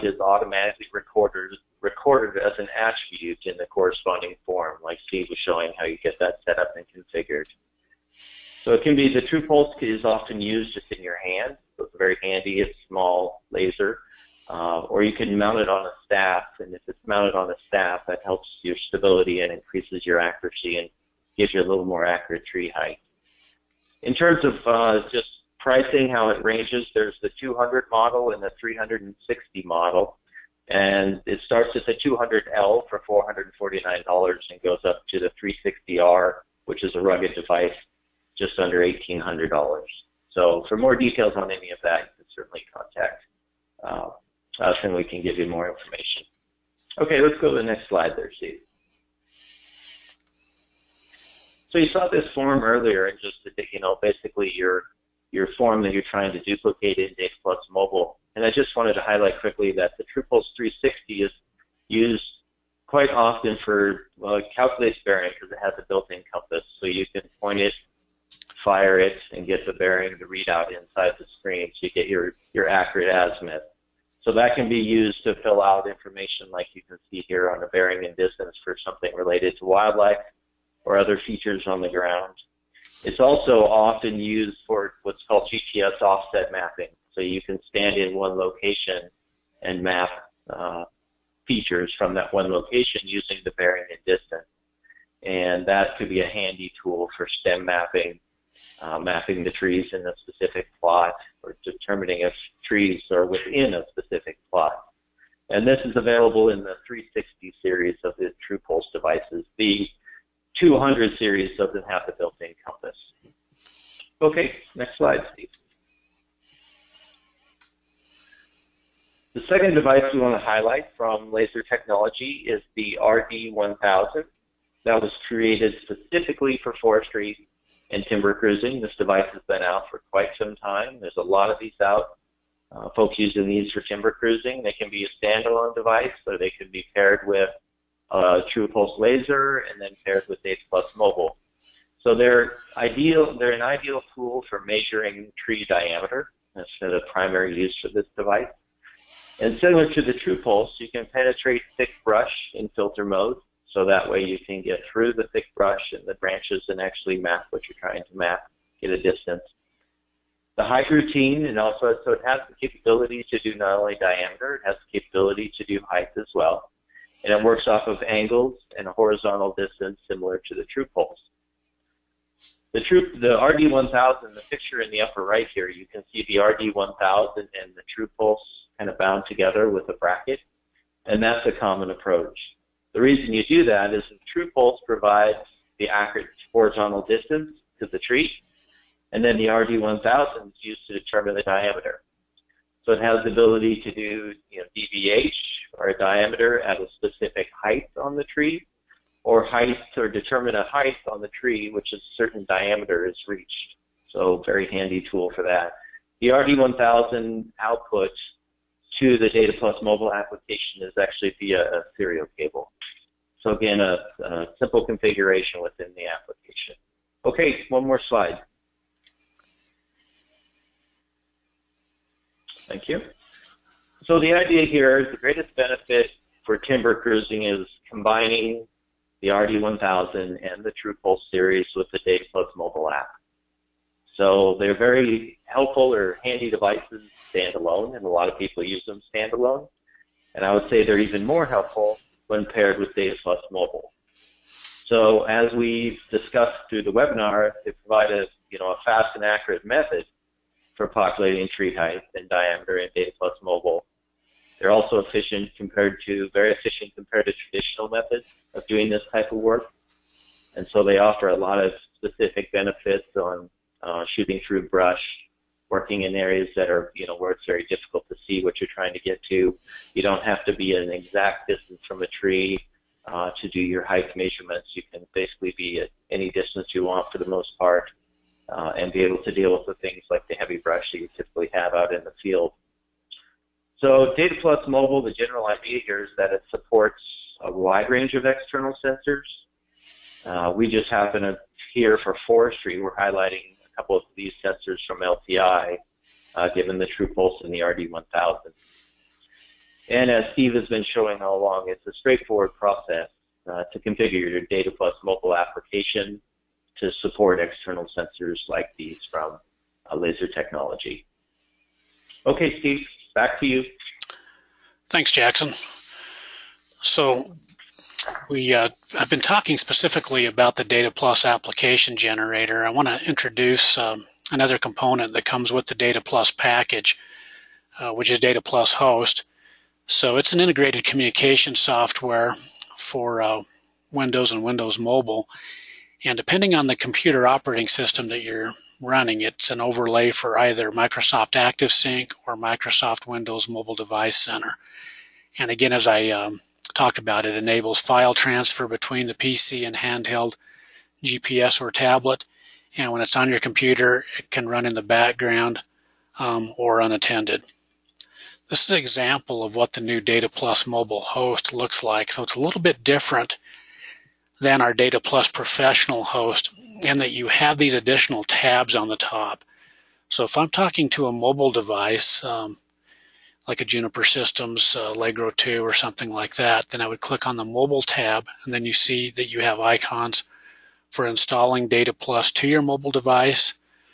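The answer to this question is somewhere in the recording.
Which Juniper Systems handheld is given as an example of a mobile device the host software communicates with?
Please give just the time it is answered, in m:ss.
6:14.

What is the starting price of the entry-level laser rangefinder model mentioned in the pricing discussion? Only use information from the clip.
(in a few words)
$449.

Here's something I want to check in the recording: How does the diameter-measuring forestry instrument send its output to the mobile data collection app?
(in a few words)
Serial cable.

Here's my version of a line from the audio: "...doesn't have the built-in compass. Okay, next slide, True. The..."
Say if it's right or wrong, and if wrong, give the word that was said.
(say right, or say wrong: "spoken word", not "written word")
wrong: "Steve", not "True".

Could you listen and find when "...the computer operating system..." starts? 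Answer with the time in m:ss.
5:36.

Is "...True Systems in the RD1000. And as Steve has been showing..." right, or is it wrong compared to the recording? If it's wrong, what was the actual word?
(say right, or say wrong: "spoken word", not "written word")
wrong: "Pulse", not "Systems".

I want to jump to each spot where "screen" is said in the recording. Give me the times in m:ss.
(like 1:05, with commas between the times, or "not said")
1:11.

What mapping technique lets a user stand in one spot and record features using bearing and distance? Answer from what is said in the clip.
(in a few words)
GPS offset mapping.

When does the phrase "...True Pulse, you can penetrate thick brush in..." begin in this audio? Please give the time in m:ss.
2:30.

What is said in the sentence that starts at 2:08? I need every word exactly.
This device has been out for quite some time.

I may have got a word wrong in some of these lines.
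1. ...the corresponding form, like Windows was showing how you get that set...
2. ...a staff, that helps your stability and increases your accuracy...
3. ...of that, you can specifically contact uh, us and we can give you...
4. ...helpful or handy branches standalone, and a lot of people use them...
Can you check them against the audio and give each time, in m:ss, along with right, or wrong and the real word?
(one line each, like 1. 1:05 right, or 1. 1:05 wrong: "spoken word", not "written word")
1. 0:03 wrong: "Steve", not "Windows"
2. 0:17 right
3. 0:41 wrong: "certainly", not "specifically"
4. 3:55 wrong: "devices", not "branches".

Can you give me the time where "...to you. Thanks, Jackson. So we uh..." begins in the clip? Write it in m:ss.
5:13.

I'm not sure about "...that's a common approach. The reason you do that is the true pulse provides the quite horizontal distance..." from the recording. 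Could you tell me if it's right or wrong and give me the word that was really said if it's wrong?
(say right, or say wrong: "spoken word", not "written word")
wrong: "accurate", not "quite".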